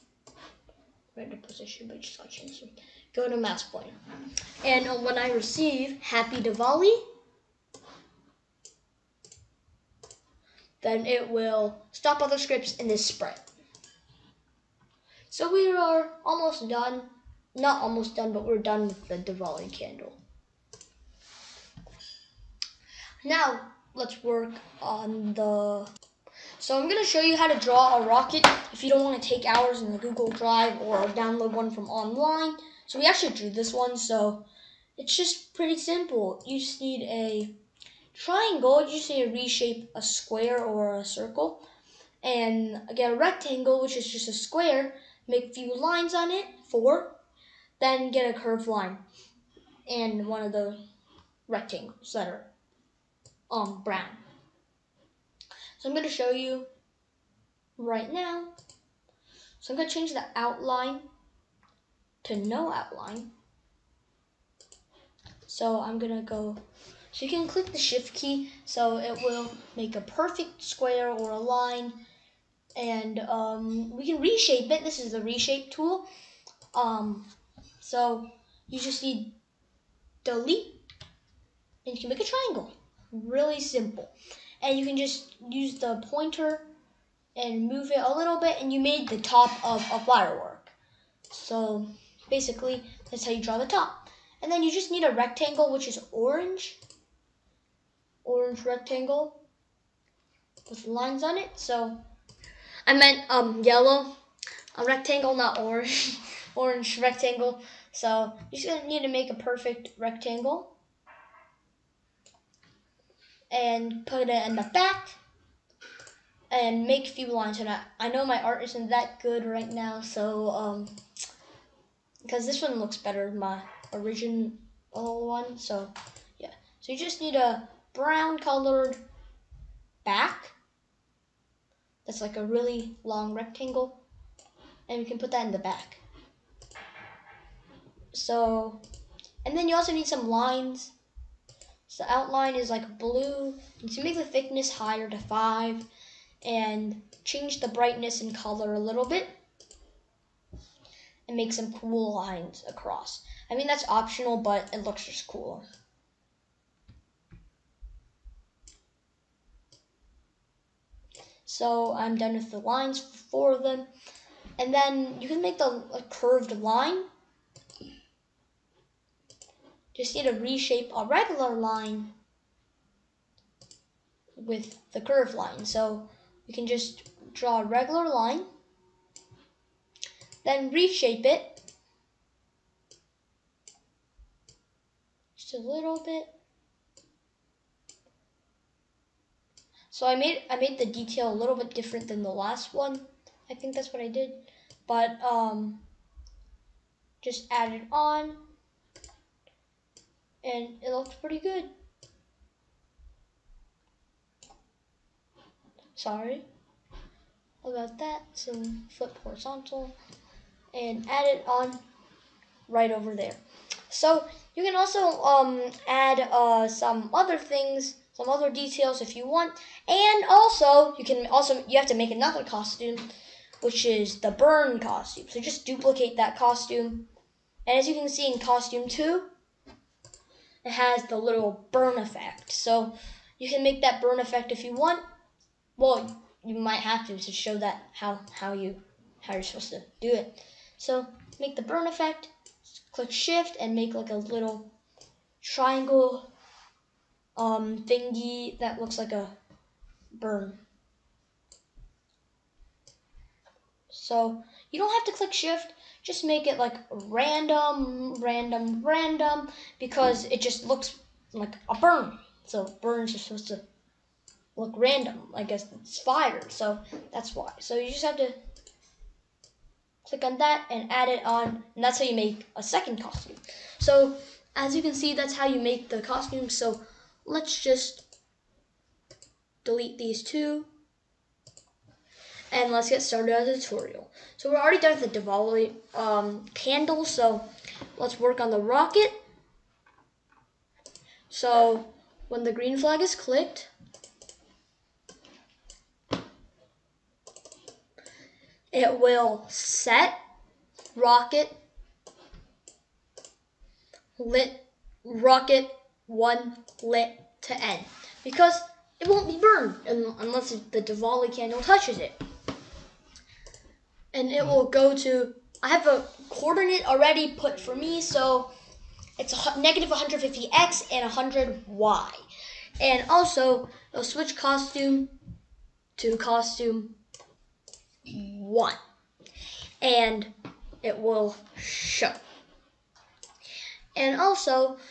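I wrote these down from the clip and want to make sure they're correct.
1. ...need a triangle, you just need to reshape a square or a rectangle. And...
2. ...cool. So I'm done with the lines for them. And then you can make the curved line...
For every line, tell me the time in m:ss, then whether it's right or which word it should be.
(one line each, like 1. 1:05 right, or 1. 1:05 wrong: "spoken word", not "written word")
1. 0:36 wrong: "circle", not "rectangle"
2. 2:35 right.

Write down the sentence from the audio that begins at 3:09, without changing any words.
So I made I made the detail a little bit different than the last one.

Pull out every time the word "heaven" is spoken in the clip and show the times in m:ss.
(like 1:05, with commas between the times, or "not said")
not said.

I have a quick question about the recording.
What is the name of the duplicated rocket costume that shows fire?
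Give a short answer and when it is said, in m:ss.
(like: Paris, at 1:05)
burn costume, at 3:44.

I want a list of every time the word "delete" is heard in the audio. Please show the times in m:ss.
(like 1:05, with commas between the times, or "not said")
1:20, 4:39.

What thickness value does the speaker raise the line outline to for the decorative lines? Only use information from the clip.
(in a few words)
5.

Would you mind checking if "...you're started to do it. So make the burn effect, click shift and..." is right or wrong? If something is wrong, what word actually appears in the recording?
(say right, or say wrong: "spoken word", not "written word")
wrong: "supposed", not "started".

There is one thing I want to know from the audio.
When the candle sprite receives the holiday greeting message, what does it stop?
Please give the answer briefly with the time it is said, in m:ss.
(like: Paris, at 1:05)
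other scripts in this sprite, at 0:12.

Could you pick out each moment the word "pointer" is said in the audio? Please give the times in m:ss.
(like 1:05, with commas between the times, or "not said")
0:03, 1:26.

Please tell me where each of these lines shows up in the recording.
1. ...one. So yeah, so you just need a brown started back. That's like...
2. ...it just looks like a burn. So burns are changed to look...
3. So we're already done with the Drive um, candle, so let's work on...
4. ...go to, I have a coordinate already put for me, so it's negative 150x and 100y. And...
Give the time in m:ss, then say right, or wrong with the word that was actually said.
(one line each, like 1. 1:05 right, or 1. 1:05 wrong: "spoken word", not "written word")
1. 2:04 wrong: "colored", not "started"
2. 4:20 wrong: "supposed", not "changed"
3. 4:44 wrong: "Diwali", not "Drive"
4. 5:14 right.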